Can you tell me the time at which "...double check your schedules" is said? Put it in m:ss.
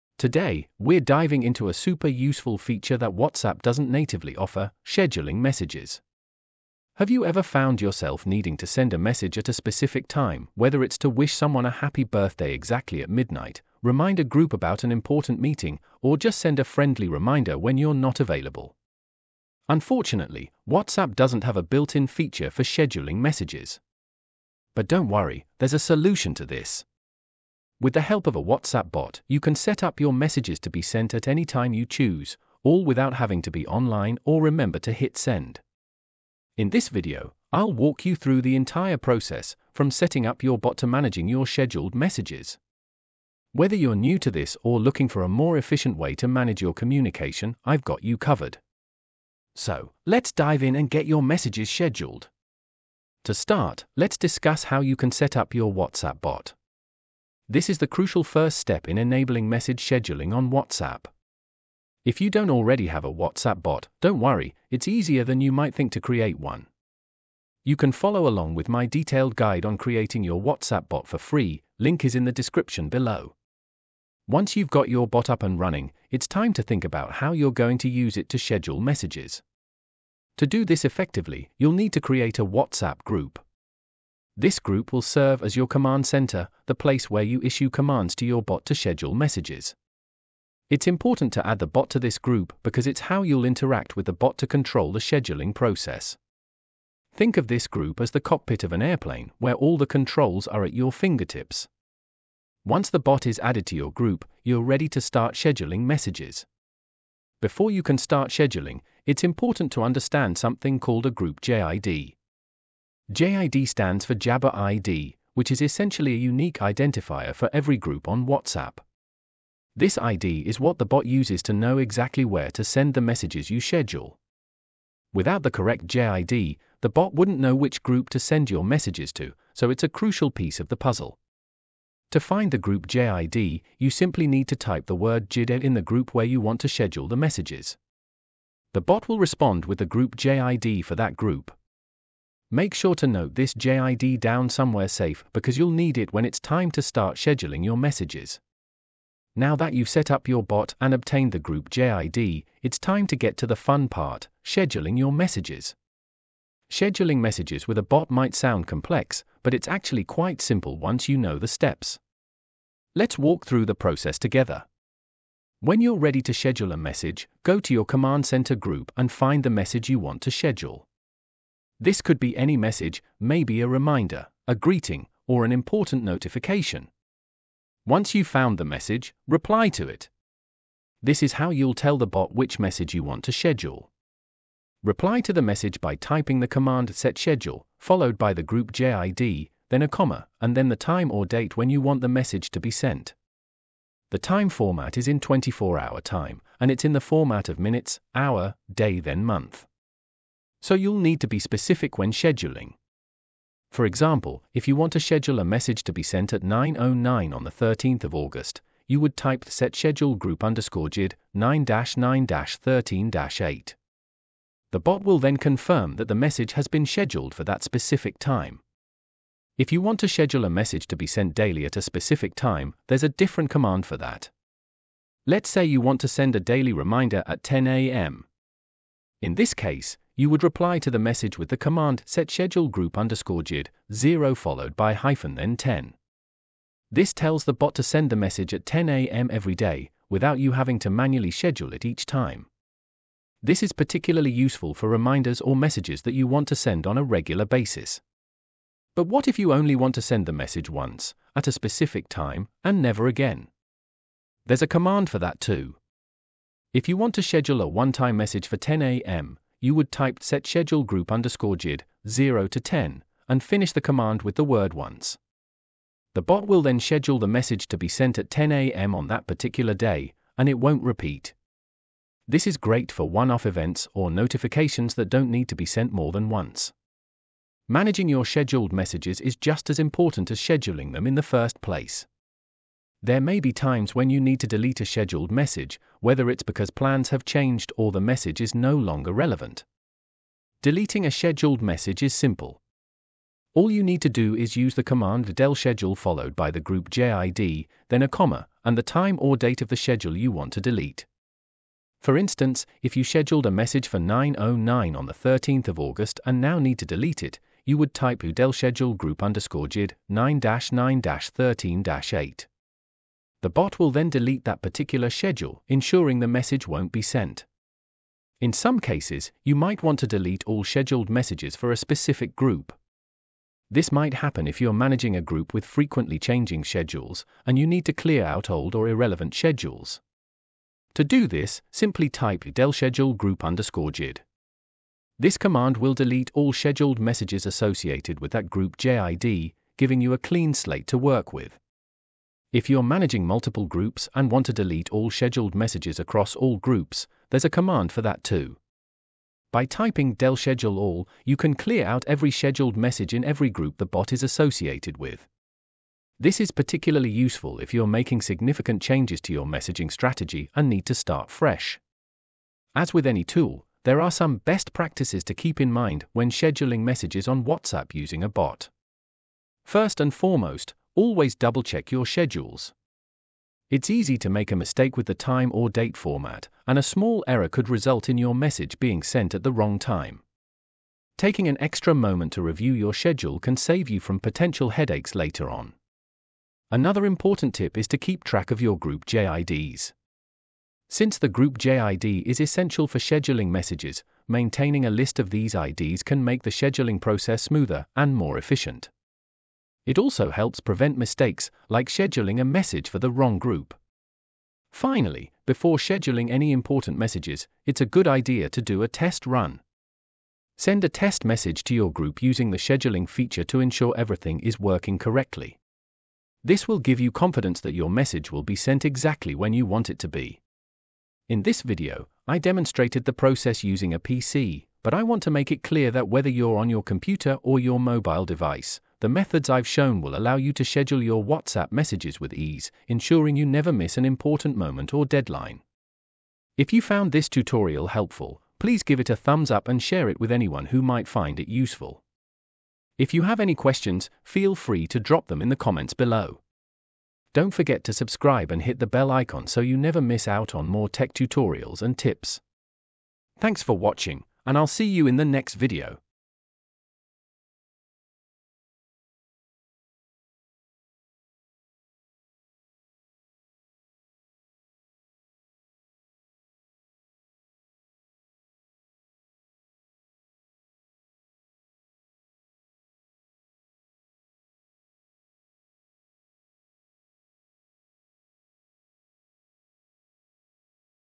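6:11.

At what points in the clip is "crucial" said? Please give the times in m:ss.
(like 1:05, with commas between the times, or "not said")
0:57, 2:09.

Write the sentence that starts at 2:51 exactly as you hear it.
This could be any message, maybe a reminder, a greeting, or an important notification.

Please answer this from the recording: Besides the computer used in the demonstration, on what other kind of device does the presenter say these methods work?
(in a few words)
Mobile device.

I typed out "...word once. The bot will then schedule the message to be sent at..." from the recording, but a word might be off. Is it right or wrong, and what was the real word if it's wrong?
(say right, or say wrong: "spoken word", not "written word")
right.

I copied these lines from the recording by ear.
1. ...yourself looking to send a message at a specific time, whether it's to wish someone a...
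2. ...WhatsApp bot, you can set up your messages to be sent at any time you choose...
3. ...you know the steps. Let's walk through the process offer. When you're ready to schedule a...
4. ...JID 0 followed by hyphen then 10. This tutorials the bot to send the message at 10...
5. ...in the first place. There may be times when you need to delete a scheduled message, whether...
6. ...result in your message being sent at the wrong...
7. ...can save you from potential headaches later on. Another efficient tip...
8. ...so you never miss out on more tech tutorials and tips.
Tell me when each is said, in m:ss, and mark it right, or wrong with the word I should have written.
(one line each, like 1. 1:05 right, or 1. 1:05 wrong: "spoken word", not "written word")
1. 0:07 wrong: "needing", not "looking"
2. 0:28 right
3. 2:41 wrong: "together", not "offer"
4. 3:53 wrong: "tells", not "tutorials"
5. 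4:41 right
6. 6:17 right
7. 6:23 wrong: "important", not "efficient"
8. 7:29 right.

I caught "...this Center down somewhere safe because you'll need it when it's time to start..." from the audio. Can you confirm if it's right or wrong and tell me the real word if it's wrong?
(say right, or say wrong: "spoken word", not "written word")
wrong: "JID", not "Center".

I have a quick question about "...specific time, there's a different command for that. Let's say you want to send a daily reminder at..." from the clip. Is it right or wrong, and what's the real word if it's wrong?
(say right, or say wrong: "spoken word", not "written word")
right.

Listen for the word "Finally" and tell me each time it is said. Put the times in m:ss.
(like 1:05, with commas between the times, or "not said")
6:44.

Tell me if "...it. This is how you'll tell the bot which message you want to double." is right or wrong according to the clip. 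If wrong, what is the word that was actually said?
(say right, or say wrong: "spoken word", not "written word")
wrong: "schedule", not "double".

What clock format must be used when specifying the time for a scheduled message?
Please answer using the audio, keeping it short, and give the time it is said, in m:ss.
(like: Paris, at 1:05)
24 hour time, at 3:15.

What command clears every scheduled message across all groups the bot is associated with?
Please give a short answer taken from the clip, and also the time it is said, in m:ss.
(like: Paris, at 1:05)
del schedule all, at 5:50.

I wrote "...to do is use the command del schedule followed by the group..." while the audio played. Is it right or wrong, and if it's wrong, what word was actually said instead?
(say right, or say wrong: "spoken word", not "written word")
right.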